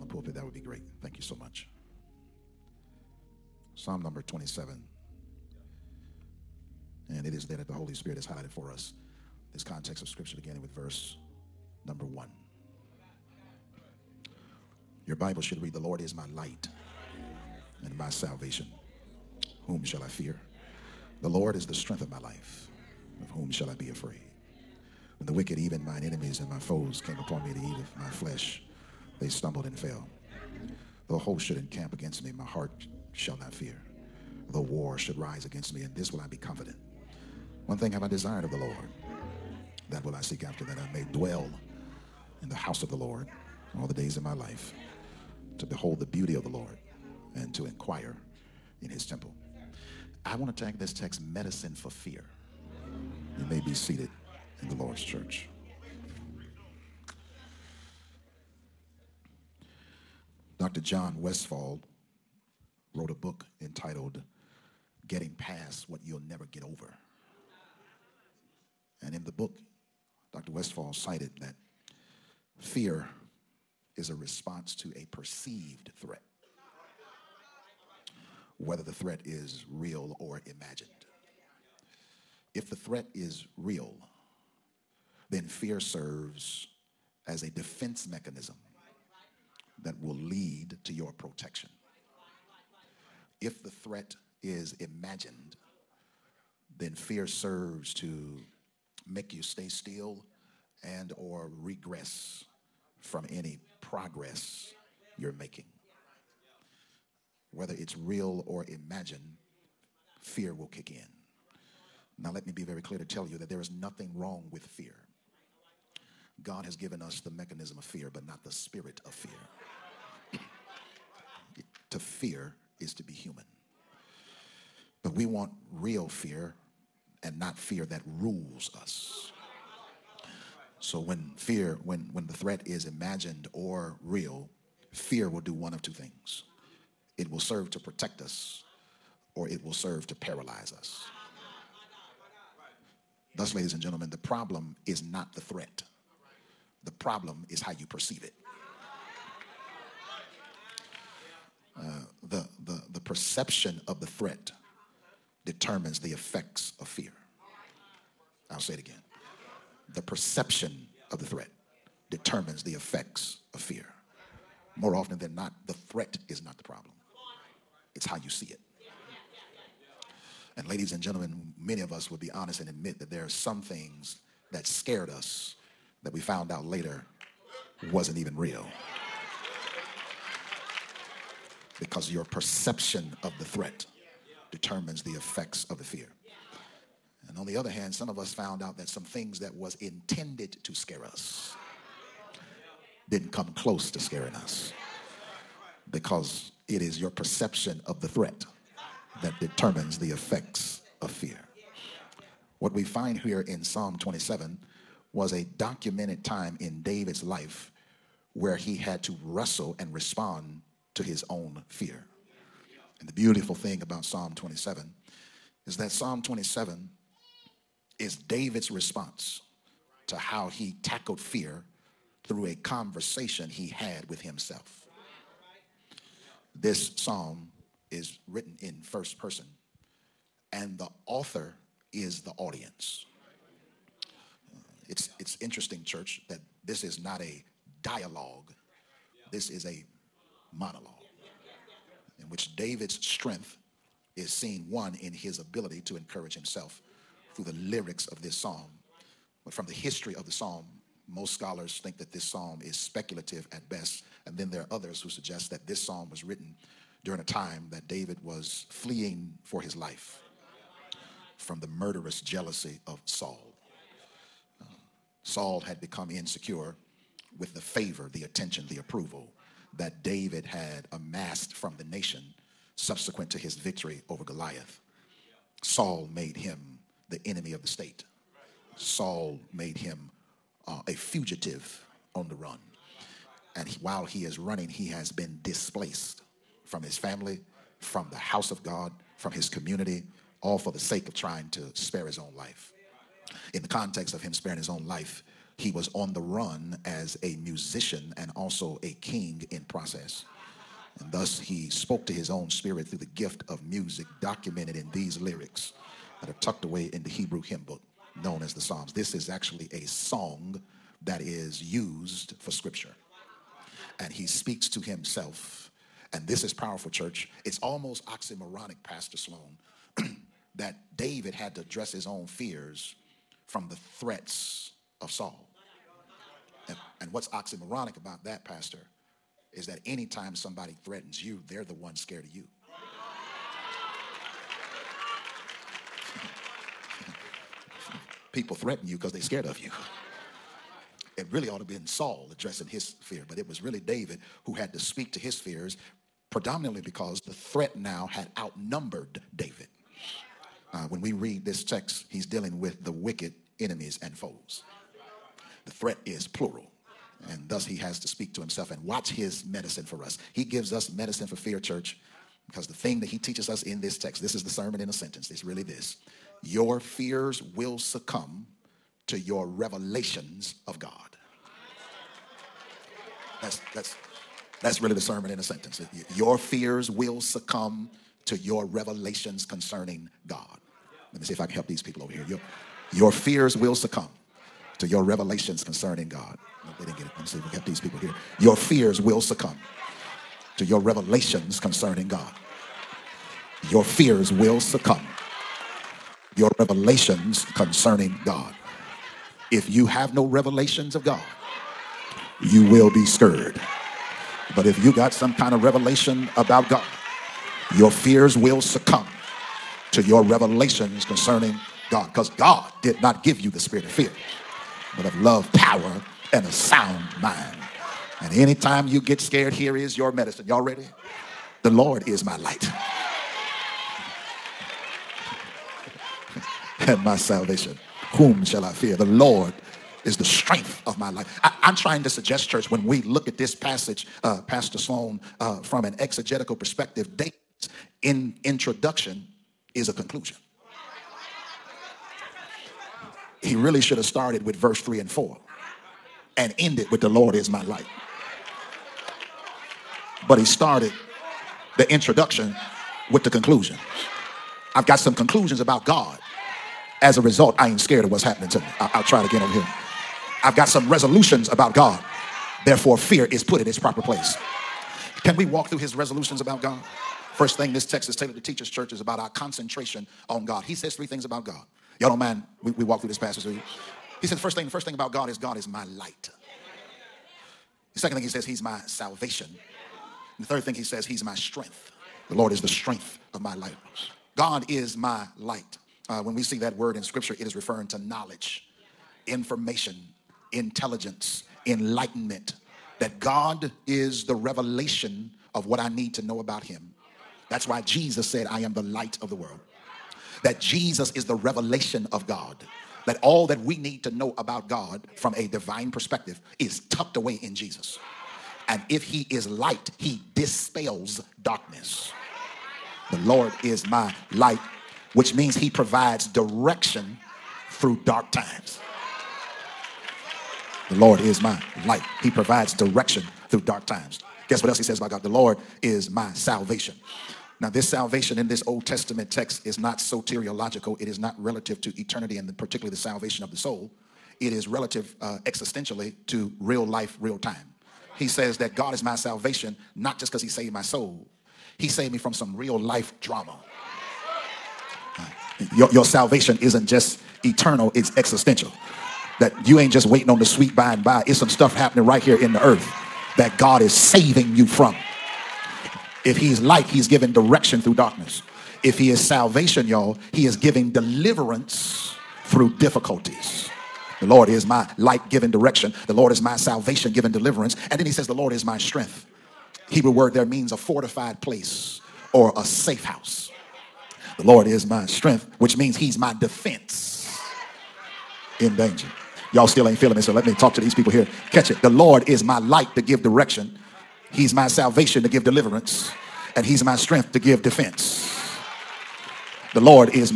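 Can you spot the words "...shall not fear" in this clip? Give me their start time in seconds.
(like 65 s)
33 s.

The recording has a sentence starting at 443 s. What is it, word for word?
He really should have started with verse 3 and 4 and ended with the Lord is my light.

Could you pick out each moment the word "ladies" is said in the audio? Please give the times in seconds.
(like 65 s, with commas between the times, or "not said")
143 s, 170 s.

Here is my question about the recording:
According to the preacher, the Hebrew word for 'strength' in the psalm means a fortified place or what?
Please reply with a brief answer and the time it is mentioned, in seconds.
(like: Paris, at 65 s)
A safe house, at 572 s.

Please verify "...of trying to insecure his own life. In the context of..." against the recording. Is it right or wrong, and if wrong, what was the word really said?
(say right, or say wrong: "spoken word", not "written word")
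wrong: "spare", not "insecure".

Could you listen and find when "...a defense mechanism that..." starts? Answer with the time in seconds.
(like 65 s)
87 s.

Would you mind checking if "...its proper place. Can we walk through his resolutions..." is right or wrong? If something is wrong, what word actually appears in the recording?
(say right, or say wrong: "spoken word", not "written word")
right.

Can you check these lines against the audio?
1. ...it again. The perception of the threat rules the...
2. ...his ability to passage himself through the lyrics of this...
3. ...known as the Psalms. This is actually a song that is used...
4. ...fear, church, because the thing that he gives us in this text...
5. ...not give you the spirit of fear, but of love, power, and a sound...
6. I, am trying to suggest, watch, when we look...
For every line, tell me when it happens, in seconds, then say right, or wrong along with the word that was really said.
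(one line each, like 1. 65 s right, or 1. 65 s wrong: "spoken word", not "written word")
1. 158 s wrong: "determines", not "rules"
2. 245 s wrong: "encourage", not "passage"
3. 308 s right
4. 361 s wrong: "teaches", not "gives"
5. 413 s right
6. 431 s wrong: "church", not "watch".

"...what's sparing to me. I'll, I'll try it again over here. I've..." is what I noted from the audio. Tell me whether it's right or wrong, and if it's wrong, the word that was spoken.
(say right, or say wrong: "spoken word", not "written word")
wrong: "happening", not "sparing".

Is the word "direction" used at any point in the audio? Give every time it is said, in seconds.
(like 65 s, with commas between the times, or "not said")
516 s, 522 s, 557 s, 565 s, 583 s.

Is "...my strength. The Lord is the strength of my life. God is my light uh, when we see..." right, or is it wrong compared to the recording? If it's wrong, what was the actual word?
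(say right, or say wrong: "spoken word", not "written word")
right.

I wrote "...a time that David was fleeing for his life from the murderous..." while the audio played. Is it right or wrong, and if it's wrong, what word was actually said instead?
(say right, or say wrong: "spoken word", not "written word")
right.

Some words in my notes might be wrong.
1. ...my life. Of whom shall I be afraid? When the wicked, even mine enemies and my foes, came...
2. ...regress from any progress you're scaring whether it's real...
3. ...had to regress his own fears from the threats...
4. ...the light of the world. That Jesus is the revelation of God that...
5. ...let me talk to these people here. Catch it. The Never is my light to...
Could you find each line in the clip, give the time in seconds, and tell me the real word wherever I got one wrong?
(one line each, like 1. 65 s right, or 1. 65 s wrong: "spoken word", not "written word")
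1. 22 s right
2. 101 s wrong: "making", not "scaring"
3. 321 s wrong: "address", not "regress"
4. 498 s right
5. 580 s wrong: "Lord", not "Never".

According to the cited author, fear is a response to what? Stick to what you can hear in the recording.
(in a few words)
A perceived threat.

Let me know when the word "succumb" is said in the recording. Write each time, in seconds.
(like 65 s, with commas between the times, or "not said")
367 s, 377 s, 383 s, 389 s, 394 s, 408 s.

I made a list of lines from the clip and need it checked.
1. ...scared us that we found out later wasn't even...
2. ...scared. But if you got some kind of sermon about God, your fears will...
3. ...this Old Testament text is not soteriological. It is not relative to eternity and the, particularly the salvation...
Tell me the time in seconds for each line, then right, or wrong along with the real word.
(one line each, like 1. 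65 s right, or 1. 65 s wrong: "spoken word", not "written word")
1. 174 s right
2. 403 s wrong: "revelation", not "sermon"
3. 528 s right.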